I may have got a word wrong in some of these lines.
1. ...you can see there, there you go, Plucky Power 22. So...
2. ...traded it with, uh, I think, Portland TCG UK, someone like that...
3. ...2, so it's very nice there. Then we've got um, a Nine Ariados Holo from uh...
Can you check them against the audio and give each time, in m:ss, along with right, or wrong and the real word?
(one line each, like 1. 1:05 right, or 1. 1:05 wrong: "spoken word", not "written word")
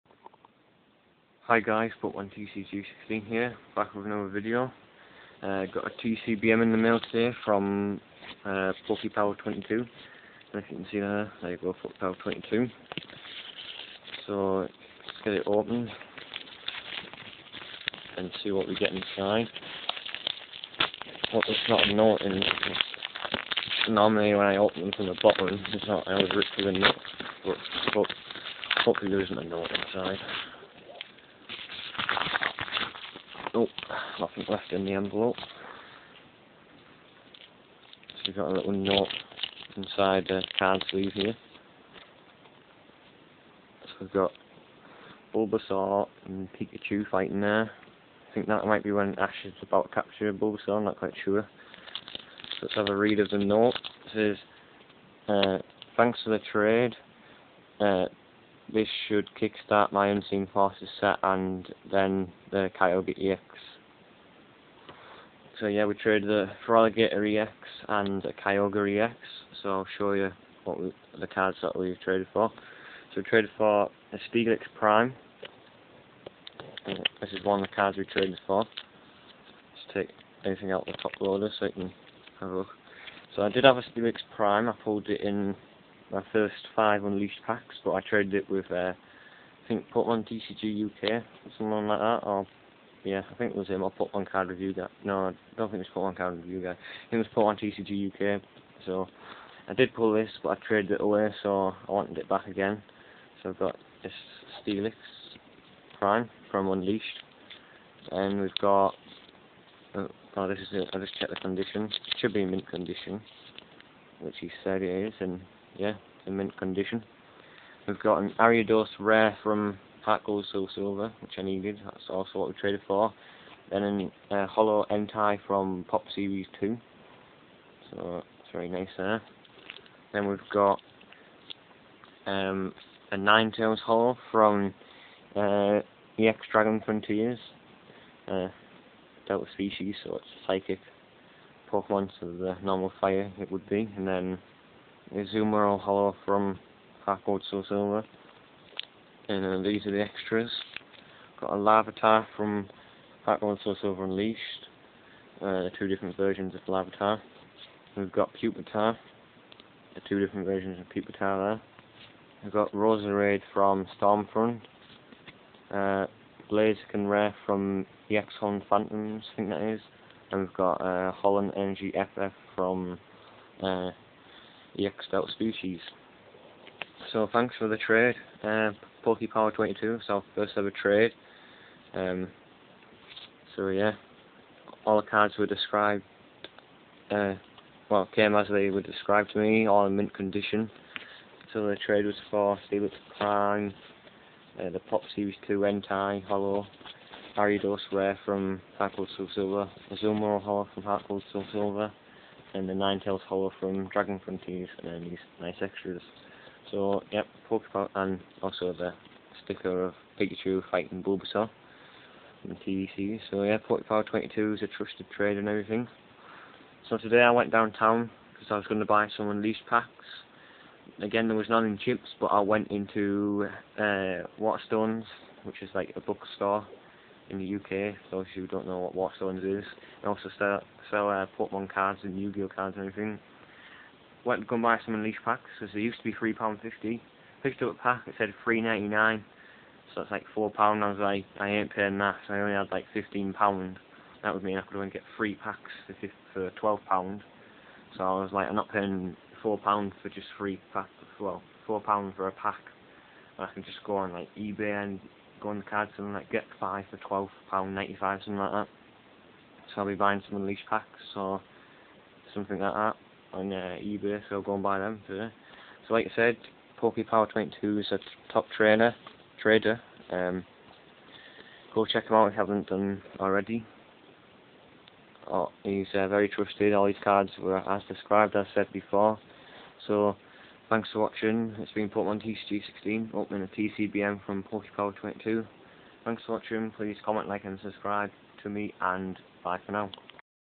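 1. 0:10 right
2. 1:28 right
3. 2:06 wrong: "Tails", not "Ariados".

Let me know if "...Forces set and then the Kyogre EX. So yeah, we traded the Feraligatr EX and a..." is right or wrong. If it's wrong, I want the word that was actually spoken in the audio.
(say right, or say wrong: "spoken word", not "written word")
right.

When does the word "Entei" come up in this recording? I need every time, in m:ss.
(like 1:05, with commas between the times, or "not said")
2:04, 3:15.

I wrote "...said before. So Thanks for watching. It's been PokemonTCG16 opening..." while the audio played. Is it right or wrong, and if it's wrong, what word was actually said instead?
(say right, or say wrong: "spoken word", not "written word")
right.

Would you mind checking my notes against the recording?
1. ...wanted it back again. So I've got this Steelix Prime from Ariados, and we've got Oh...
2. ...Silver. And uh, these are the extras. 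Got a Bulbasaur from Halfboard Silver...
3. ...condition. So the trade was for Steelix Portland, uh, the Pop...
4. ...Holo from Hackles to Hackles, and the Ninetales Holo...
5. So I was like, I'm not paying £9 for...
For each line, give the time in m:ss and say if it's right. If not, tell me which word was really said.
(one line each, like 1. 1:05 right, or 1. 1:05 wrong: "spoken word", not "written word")
1. 1:41 wrong: "Unleashed", not "Ariados"
2. 2:27 wrong: "Larvitar", not "Bulbasaur"
3. 3:10 wrong: "Prime", not "Portland"
4. 3:20 wrong: "Silver", not "Hackles"
5. 4:07 wrong: "4", not "9".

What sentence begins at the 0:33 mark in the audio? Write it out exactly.
Oh, nothing left in the envelope.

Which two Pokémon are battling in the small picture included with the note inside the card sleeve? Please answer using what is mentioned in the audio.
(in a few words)
Bulbasaur and Pikachu.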